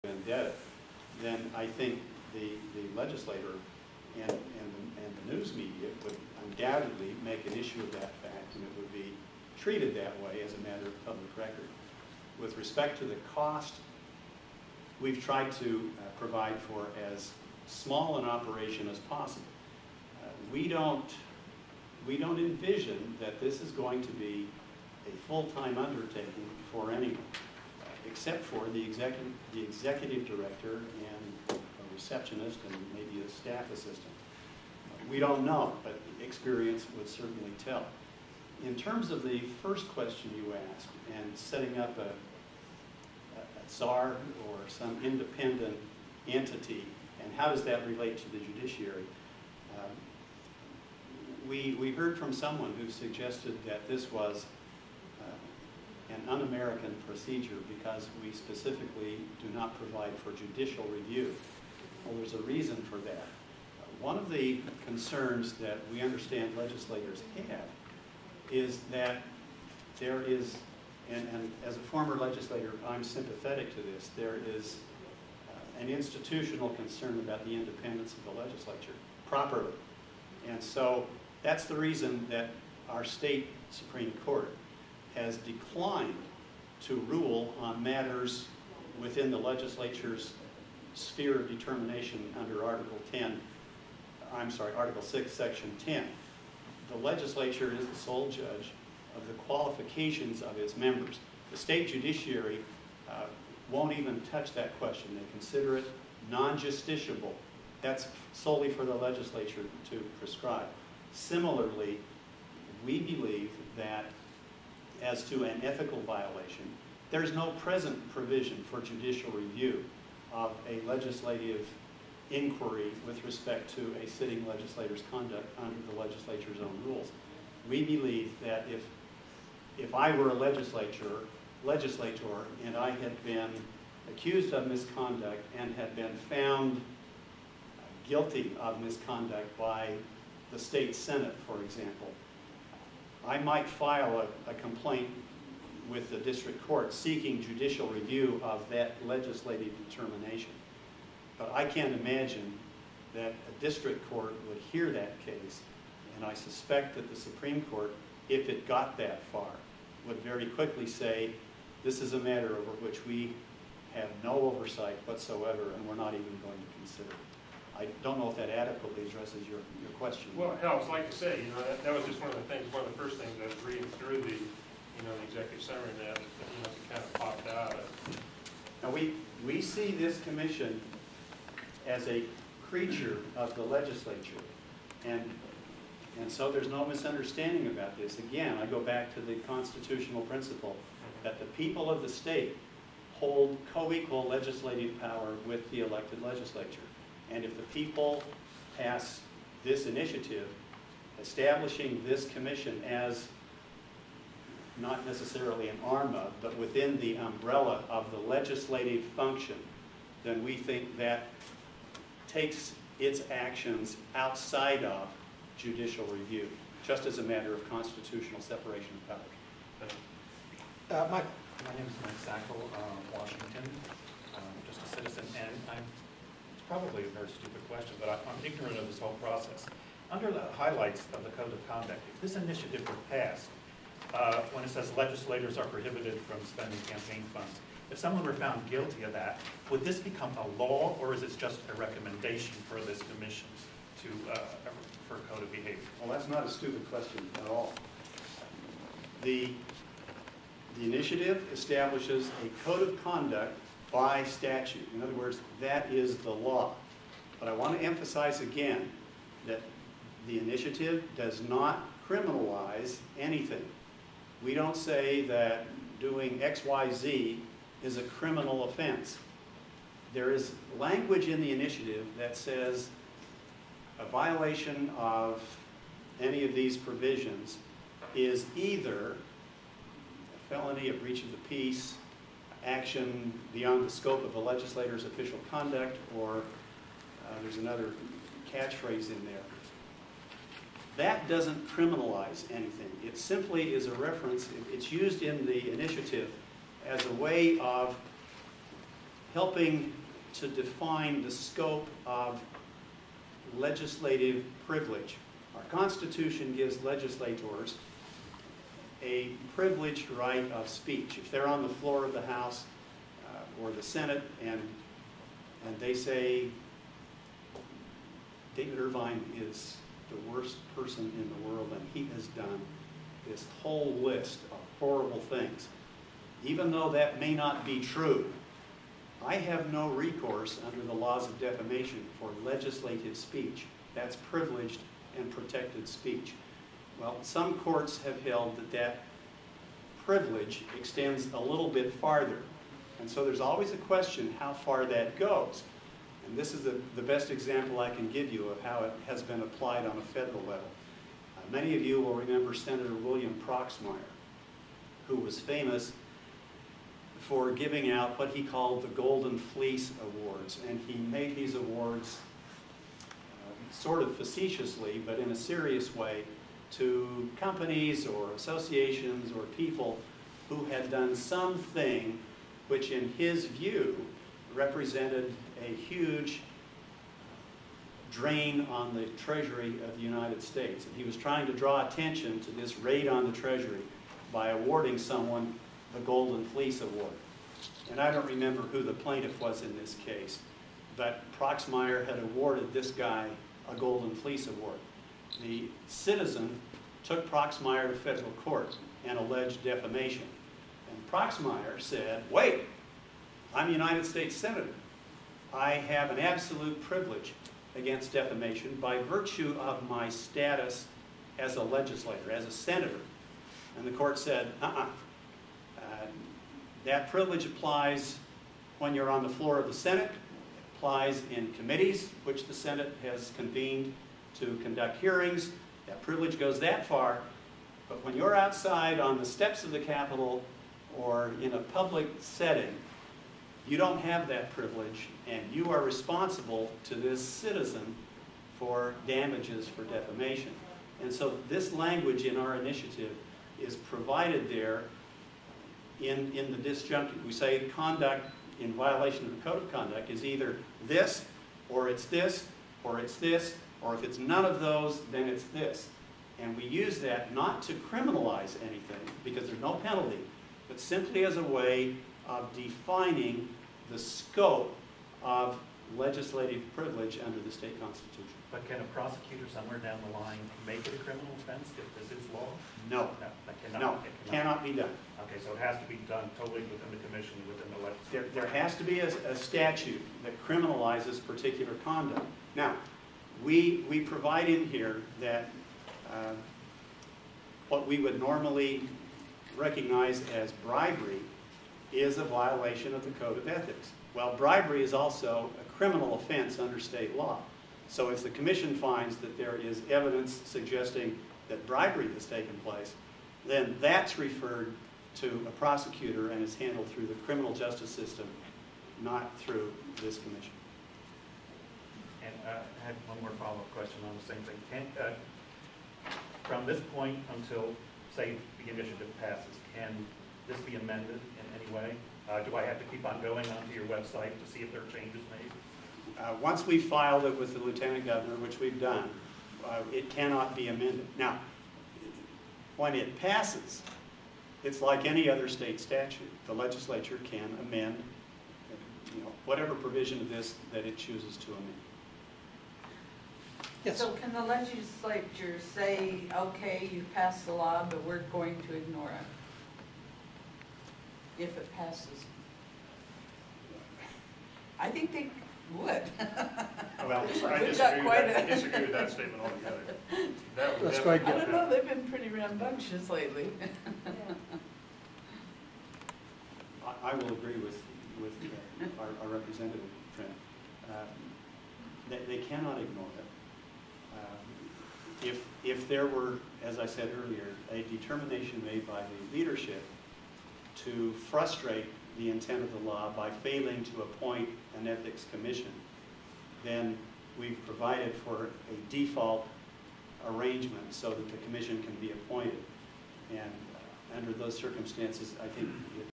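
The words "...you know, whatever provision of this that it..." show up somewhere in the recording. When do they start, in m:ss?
8:59.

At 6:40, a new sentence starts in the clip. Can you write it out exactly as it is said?
And Proxmire said, wait, I'm a United States Senator.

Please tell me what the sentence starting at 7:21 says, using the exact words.
And so this language in our initiative is provided there in, in the disjunctive.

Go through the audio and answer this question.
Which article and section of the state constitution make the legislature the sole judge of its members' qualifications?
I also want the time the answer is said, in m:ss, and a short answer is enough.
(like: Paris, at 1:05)
Article 6, Section 10, at 1:34.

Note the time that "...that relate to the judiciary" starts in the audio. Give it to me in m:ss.
0:47.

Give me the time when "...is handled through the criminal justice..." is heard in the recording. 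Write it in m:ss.
8:26.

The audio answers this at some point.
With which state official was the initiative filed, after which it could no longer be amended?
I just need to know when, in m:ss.
8:47.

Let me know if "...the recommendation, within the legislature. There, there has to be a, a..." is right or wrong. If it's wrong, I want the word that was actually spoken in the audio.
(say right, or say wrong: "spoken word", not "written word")
wrong: "commission", not "recommendation".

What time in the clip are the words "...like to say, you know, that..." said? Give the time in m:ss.
2:50.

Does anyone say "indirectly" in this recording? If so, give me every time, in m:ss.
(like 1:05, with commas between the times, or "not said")
not said.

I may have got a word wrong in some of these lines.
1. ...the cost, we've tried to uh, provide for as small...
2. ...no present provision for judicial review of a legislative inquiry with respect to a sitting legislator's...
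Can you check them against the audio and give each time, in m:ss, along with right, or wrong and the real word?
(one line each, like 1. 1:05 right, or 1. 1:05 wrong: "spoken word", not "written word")
1. 0:13 right
2. 1:57 right.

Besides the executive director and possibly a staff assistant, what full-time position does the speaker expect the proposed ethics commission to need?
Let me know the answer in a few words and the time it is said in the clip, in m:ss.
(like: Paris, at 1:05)
Receptionist, at 0:31.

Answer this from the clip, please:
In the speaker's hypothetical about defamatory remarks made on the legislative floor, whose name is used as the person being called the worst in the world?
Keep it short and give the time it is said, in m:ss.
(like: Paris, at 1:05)
David Irvine, at 5:18.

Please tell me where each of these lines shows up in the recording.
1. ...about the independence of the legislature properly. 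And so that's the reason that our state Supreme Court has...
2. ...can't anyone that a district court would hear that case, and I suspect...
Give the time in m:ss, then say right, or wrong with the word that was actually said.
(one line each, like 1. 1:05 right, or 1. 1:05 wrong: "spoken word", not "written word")
1. 1:17 right
2. 2:31 wrong: "imagine", not "anyone".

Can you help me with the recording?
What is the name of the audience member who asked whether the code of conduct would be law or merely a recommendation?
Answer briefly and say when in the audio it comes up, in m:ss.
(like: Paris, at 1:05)
Mike Sackle, at 3:42.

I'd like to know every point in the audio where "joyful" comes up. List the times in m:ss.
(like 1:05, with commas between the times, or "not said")
not said.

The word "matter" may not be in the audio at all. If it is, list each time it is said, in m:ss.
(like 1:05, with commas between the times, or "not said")
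0:10, 1:27, 2:42, 3:37.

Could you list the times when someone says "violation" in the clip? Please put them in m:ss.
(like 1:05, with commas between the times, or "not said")
1:56, 4:34, 7:28, 8:12.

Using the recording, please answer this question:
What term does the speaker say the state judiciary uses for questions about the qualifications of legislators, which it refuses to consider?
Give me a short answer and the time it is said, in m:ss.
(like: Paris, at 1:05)
Non-justiciable, at 1:46.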